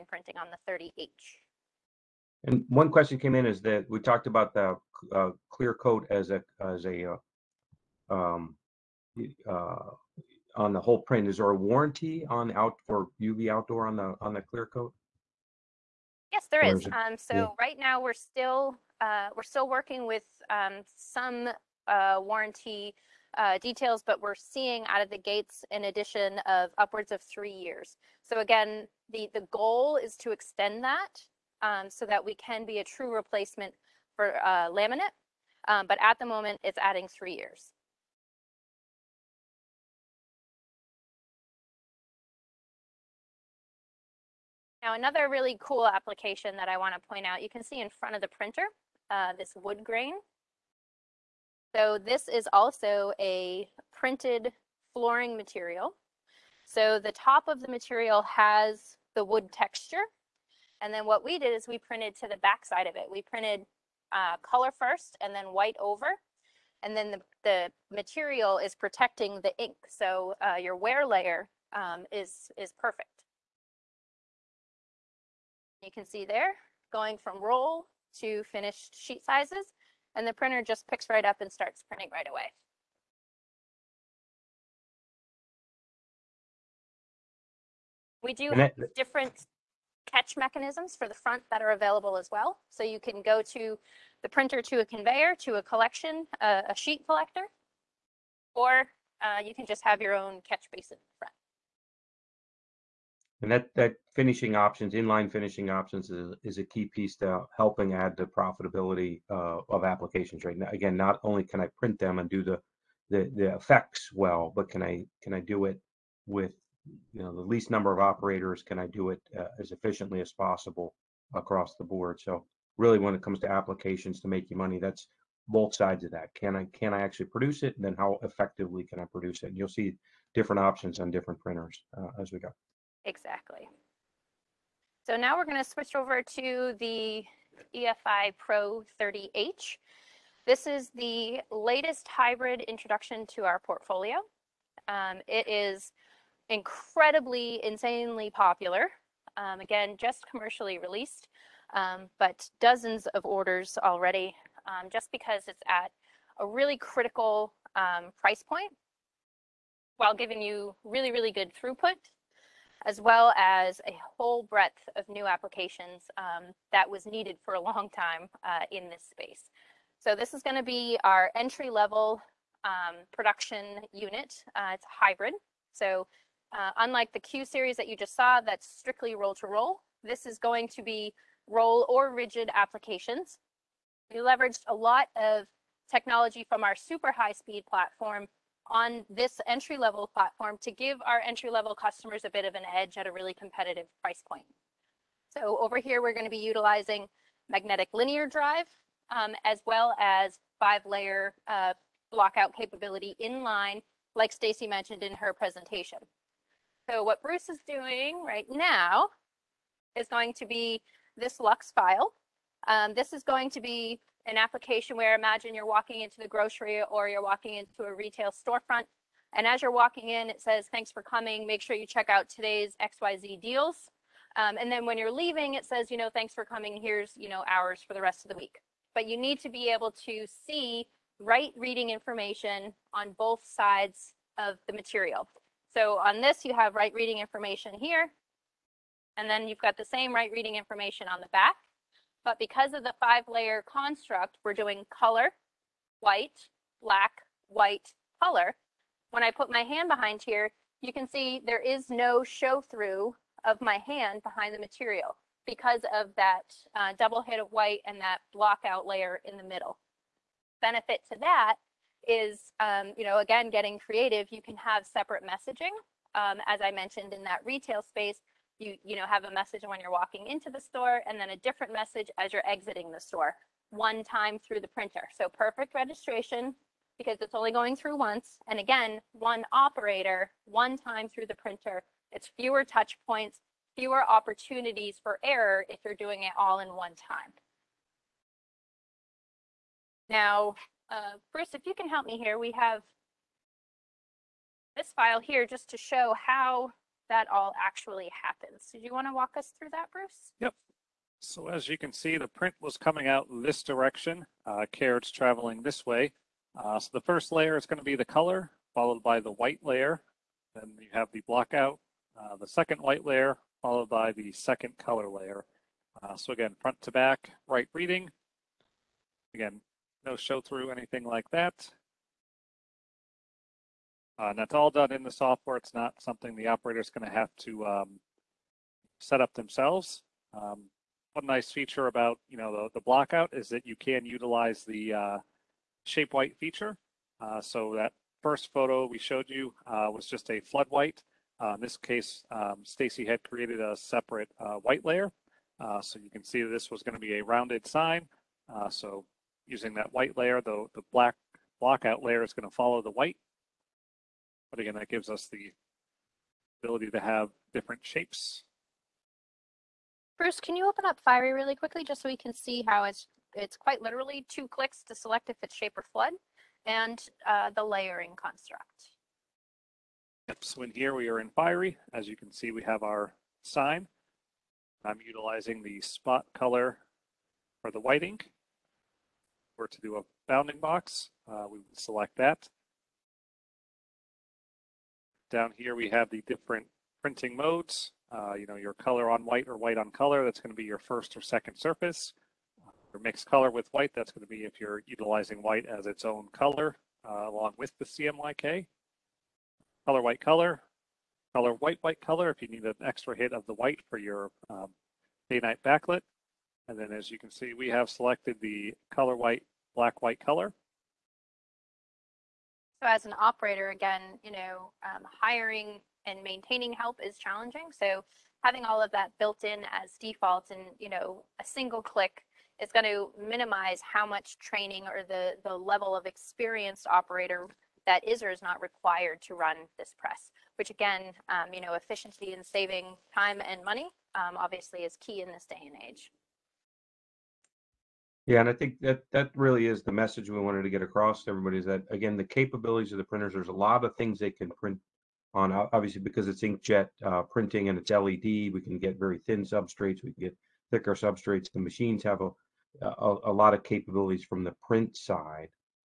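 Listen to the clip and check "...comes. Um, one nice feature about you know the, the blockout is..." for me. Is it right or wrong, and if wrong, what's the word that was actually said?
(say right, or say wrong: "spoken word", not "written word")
wrong: "themselves", not "comes".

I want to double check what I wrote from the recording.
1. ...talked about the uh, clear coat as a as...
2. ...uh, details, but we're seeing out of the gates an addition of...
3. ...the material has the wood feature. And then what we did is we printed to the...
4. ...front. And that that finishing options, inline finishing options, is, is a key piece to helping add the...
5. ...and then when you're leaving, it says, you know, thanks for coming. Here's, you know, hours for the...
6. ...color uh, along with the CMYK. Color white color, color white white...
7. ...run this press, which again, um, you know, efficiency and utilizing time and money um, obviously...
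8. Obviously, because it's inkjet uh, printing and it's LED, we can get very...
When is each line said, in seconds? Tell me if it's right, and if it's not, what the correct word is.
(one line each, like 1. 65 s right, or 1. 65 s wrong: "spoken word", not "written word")
1. 3 s right
2. 23 s right
3. 57 s wrong: "texture", not "feature"
4. 101 s right
5. 224 s right
6. 396 s right
7. 429 s wrong: "saving", not "utilizing"
8. 445 s right.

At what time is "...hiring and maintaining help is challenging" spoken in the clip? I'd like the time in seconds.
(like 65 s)
415 s.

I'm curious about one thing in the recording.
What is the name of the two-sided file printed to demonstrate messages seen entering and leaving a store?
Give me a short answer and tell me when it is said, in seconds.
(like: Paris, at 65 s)
Lux file, at 211 s.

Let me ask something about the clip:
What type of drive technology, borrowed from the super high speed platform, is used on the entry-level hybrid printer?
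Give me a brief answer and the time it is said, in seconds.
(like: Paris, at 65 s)
Magnetic linear drive, at 197 s.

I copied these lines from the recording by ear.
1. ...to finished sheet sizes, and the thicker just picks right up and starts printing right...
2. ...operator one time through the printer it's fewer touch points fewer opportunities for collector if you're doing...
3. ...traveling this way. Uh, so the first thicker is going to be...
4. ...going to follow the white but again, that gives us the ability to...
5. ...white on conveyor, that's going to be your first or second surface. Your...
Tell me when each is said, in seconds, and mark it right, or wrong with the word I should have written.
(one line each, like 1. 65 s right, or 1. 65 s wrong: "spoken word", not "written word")
1. 78 s wrong: "printer", not "thicker"
2. 279 s wrong: "error", not "collector"
3. 305 s wrong: "layer", not "thicker"
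4. 352 s right
5. 389 s wrong: "color", not "conveyor".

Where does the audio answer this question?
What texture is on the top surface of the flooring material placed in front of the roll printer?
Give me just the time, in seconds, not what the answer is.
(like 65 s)
49 s.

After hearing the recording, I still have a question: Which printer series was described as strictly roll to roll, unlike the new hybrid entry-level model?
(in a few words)
Q series.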